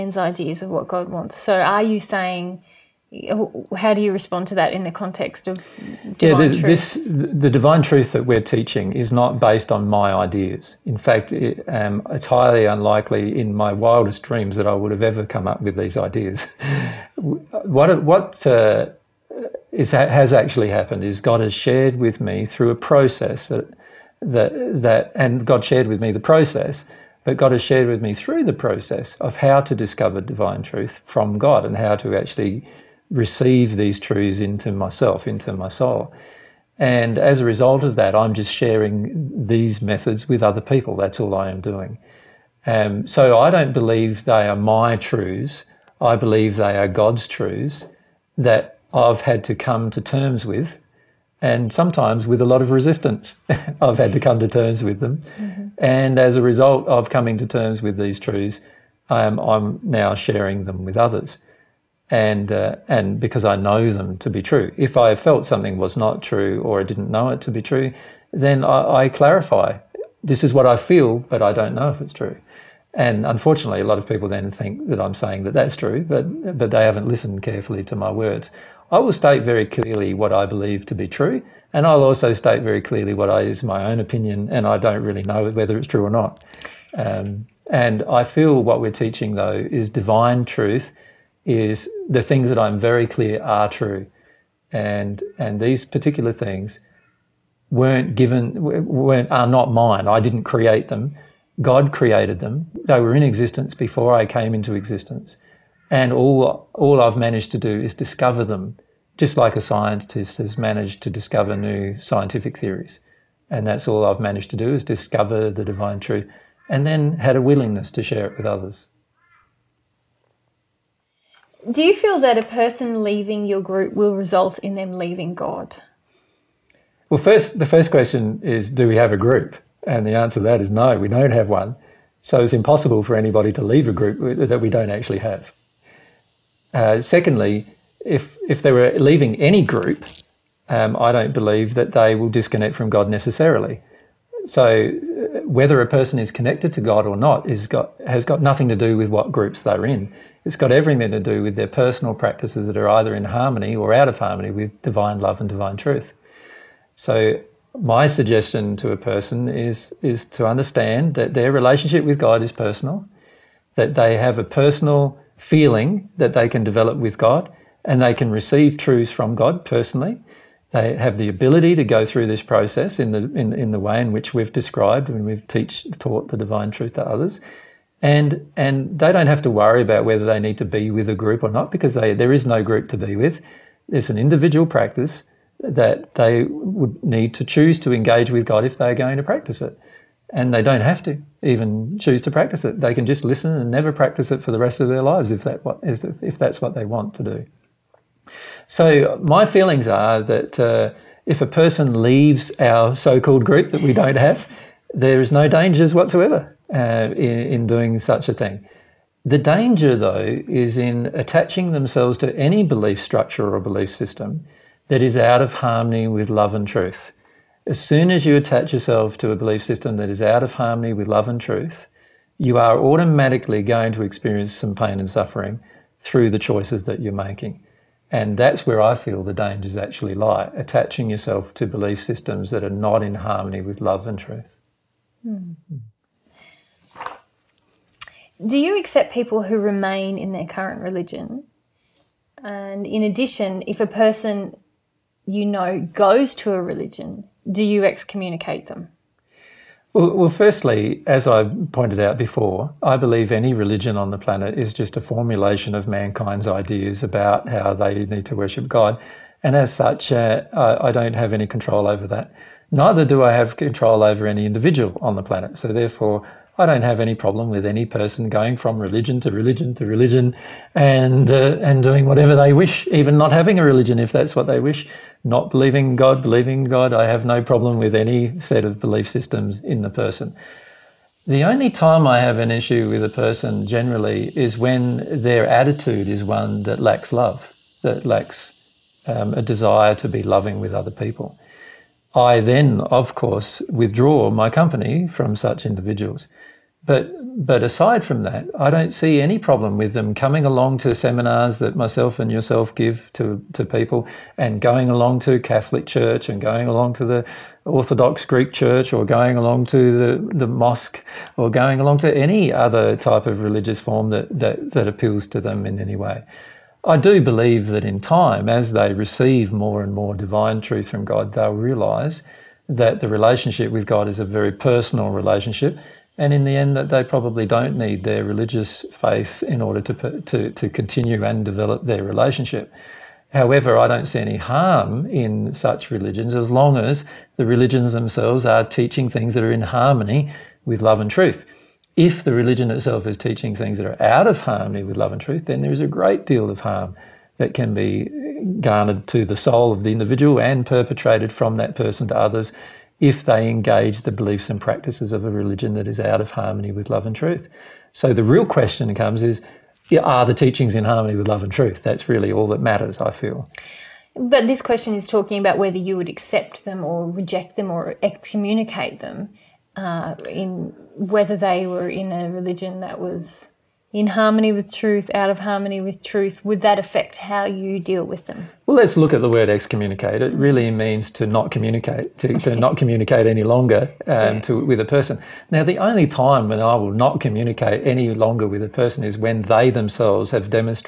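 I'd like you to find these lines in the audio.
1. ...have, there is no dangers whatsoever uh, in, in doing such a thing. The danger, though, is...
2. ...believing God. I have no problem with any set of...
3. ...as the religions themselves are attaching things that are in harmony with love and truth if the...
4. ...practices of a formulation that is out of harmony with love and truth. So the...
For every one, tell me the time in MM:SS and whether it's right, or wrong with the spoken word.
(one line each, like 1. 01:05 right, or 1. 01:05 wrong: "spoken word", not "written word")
1. 03:24 right
2. 04:36 right
3. 05:36 wrong: "teaching", not "attaching"
4. 05:54 wrong: "religion", not "formulation".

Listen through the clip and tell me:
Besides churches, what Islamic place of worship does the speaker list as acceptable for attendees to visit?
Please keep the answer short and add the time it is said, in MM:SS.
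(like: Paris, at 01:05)
The mosque, at 05:10.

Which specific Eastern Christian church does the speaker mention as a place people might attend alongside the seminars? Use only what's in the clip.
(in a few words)
Orthodox Greek Church.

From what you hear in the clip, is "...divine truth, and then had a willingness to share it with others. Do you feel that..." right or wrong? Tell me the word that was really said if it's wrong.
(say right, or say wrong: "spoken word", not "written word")
right.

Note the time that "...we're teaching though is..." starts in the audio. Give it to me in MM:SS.
01:28.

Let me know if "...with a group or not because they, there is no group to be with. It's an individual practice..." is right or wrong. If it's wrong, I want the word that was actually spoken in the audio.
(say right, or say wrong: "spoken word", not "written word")
right.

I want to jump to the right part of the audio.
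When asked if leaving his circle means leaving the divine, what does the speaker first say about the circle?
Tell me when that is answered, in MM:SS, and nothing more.
02:10.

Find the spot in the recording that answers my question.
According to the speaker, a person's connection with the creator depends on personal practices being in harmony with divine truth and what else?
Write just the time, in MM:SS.
02:34.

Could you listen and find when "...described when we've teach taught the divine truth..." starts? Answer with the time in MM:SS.
02:54.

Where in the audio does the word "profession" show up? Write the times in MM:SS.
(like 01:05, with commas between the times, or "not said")
not said.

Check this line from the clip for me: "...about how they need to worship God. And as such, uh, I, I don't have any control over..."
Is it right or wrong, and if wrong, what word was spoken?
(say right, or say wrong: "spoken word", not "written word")
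right.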